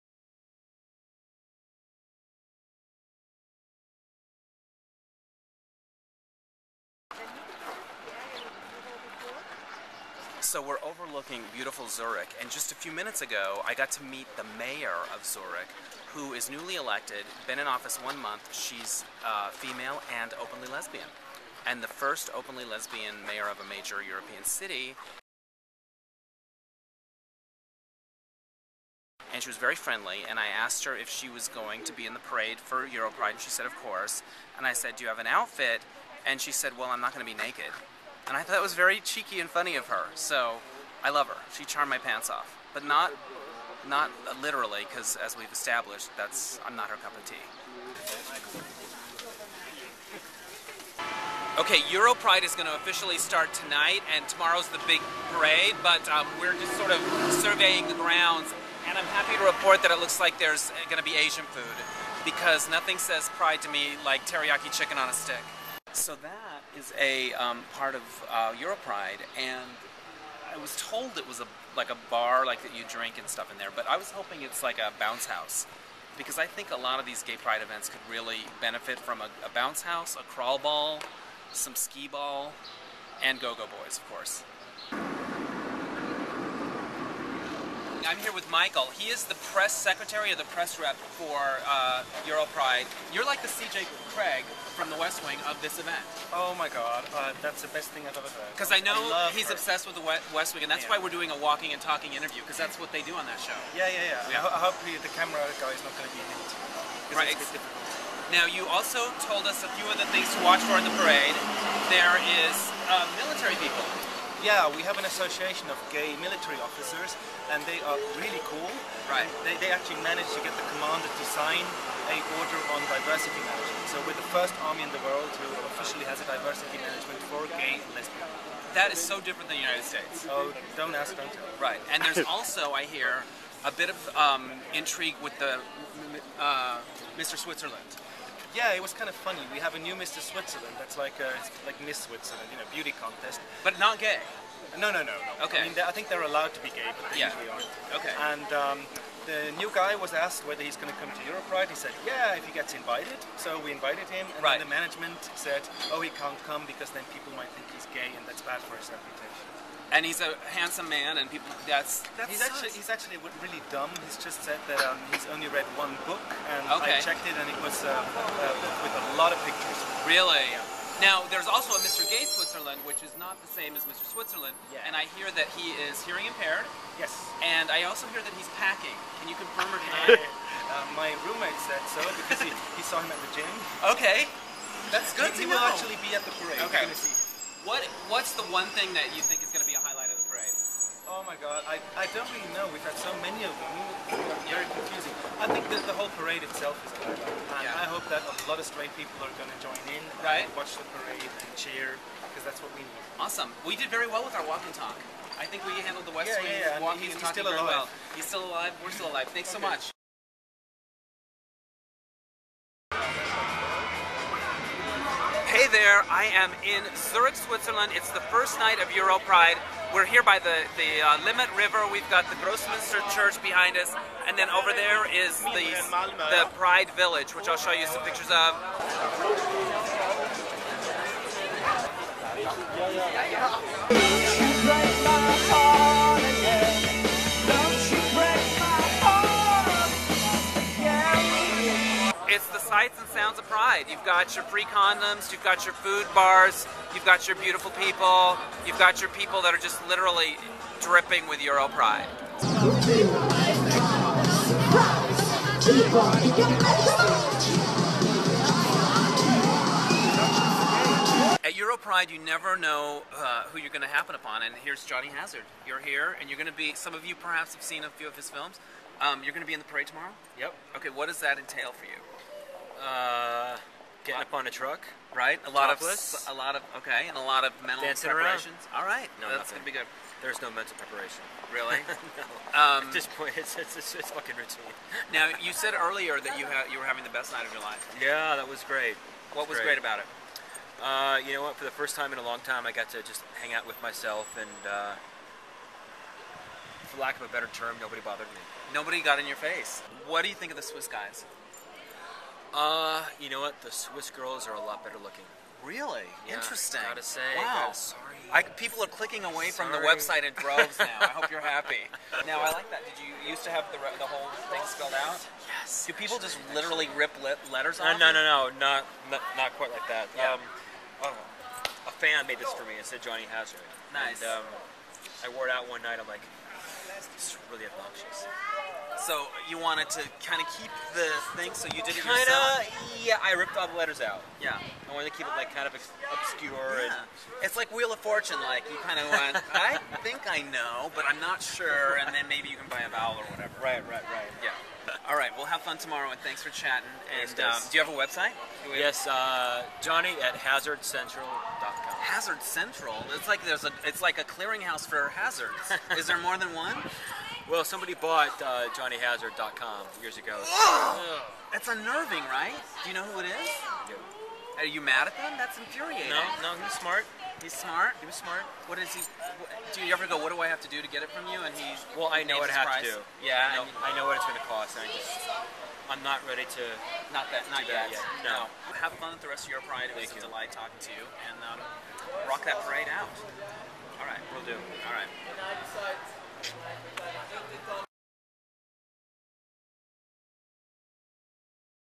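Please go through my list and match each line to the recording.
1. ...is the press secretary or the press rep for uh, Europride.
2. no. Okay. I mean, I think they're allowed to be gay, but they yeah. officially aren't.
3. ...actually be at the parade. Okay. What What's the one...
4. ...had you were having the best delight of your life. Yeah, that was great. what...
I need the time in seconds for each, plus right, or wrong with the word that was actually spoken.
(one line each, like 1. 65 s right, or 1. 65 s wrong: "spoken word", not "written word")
1. 89 s right
2. 145 s wrong: "usually", not "officially"
3. 185 s right
4. 286 s wrong: "night", not "delight".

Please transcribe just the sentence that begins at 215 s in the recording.
Hey there, I am in Zurich, Switzerland.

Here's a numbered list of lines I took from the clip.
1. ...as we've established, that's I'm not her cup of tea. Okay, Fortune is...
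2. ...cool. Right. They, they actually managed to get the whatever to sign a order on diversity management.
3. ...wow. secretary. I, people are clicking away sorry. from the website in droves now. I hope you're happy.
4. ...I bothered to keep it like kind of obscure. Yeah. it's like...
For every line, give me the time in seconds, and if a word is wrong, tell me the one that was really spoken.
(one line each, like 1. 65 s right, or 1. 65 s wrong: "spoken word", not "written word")
1. 45 s wrong: "Europride", not "Fortune"
2. 118 s wrong: "commander", not "whatever"
3. 307 s wrong: "sorry", not "secretary"
4. 334 s wrong: "wanted", not "bothered".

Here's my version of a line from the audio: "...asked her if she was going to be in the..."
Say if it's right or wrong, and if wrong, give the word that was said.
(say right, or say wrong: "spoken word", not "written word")
right.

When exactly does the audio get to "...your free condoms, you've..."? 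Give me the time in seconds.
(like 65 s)
244 s.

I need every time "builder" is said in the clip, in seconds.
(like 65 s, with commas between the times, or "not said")
not said.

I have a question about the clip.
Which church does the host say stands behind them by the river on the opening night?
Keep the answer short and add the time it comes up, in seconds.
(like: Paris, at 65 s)
Grossmünster Church, at 222 s.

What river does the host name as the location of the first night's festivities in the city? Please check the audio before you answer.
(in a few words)
Limmat River.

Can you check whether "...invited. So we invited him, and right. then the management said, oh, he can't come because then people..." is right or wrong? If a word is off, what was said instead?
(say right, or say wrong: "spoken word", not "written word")
right.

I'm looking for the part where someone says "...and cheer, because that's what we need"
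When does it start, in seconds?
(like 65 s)
201 s.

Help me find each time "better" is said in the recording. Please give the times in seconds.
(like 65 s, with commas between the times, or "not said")
297 s, 304 s.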